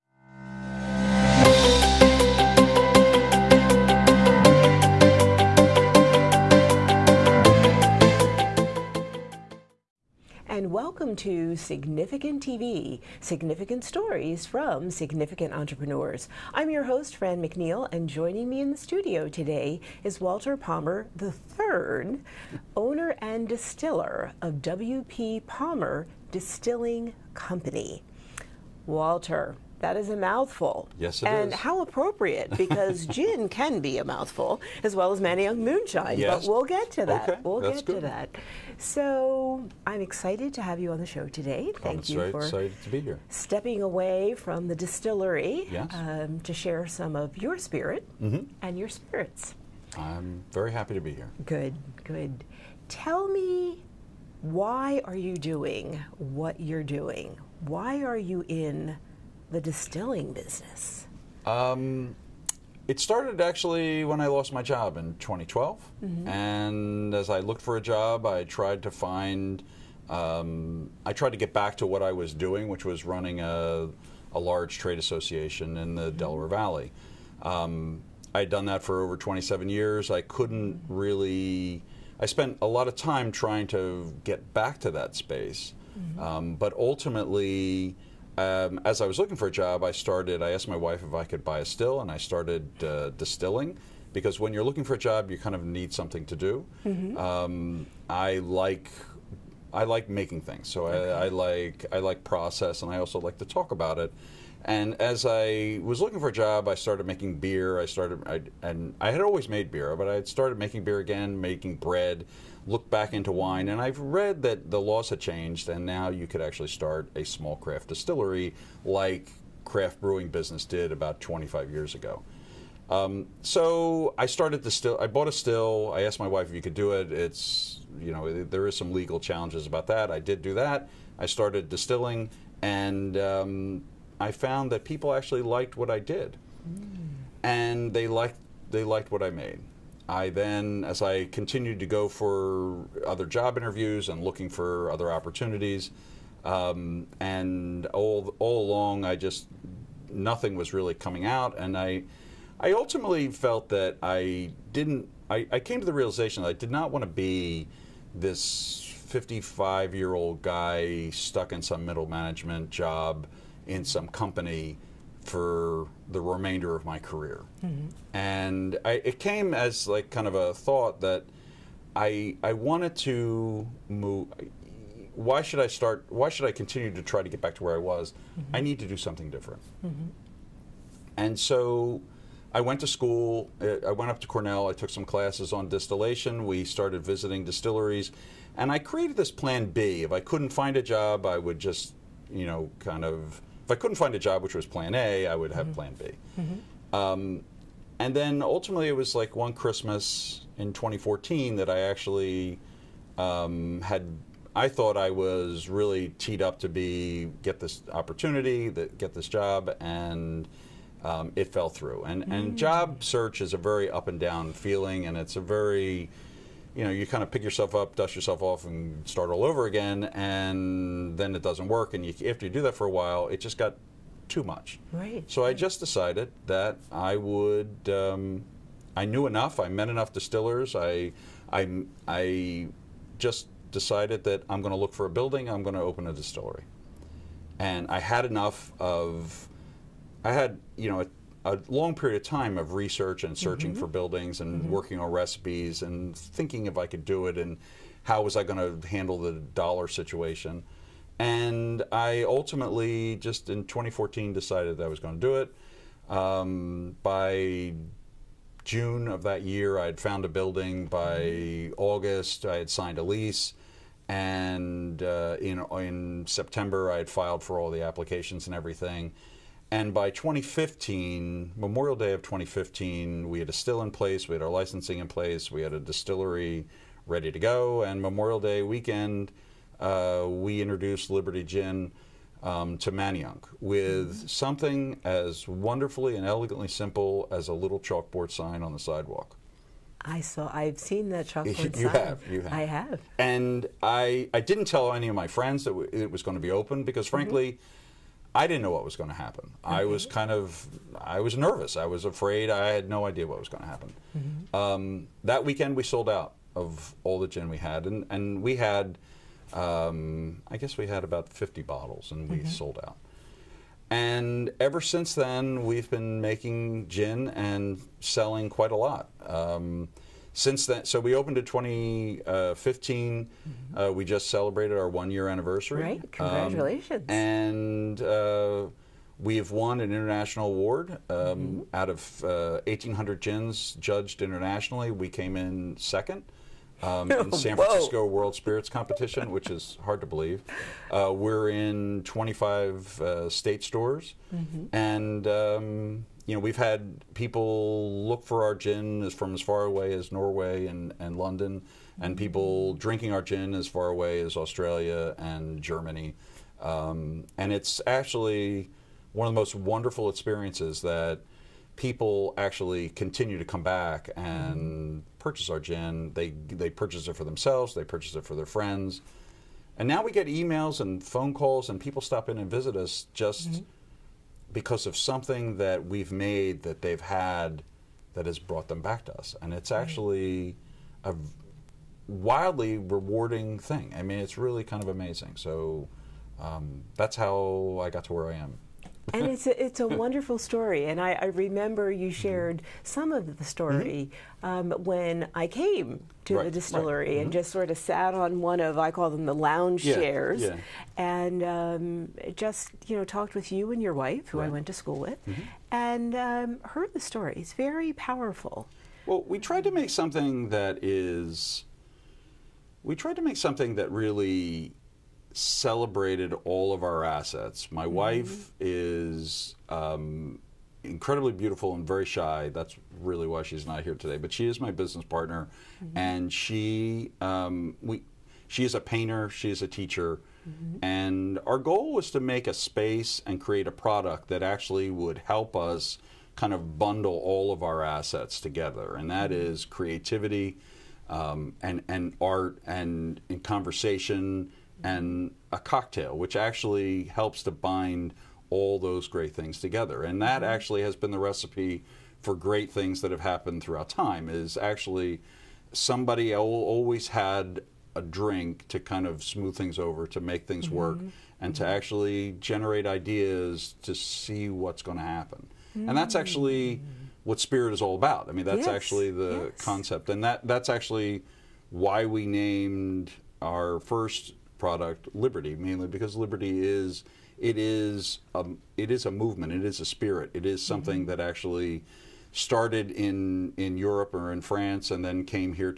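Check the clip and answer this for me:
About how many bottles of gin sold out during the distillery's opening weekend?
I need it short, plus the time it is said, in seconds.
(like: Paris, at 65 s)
50, at 311 s.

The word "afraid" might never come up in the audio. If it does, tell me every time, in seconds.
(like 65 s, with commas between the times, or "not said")
302 s.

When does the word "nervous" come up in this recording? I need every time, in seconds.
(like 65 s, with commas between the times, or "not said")
301 s.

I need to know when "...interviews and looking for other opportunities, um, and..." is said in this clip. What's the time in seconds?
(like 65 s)
143 s.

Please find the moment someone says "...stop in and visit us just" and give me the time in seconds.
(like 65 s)
371 s.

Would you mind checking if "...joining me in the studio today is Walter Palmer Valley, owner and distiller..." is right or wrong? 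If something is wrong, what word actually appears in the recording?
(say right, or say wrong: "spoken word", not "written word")
wrong: "III", not "Valley".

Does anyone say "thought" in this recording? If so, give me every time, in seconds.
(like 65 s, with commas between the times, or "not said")
170 s, 204 s.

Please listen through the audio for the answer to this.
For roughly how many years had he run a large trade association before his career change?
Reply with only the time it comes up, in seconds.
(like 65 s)
79 s.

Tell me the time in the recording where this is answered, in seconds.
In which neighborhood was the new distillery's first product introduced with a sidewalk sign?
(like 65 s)
282 s.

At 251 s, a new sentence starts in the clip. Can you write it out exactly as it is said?
And I ultimately, just in 2014, decided that I was going to do it.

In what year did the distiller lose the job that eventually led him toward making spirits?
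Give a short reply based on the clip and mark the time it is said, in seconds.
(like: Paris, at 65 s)
2012, at 65 s.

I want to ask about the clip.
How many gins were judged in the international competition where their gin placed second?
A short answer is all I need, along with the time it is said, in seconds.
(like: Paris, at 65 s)
1,800, at 332 s.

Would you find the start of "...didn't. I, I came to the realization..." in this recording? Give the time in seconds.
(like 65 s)
154 s.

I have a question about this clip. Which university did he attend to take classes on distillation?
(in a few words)
Cornell.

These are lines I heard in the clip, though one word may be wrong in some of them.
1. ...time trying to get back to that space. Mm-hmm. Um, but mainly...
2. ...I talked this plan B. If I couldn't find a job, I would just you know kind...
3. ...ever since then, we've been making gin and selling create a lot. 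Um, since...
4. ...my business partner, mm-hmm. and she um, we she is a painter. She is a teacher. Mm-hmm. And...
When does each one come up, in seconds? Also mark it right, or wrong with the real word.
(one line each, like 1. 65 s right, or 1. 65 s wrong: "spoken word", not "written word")
1. 82 s wrong: "ultimately", not "mainly"
2. 188 s wrong: "created", not "talked"
3. 314 s wrong: "quite", not "create"
4. 424 s right.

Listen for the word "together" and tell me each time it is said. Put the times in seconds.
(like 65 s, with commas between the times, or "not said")
438 s, 449 s.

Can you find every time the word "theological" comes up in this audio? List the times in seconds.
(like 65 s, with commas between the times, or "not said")
not said.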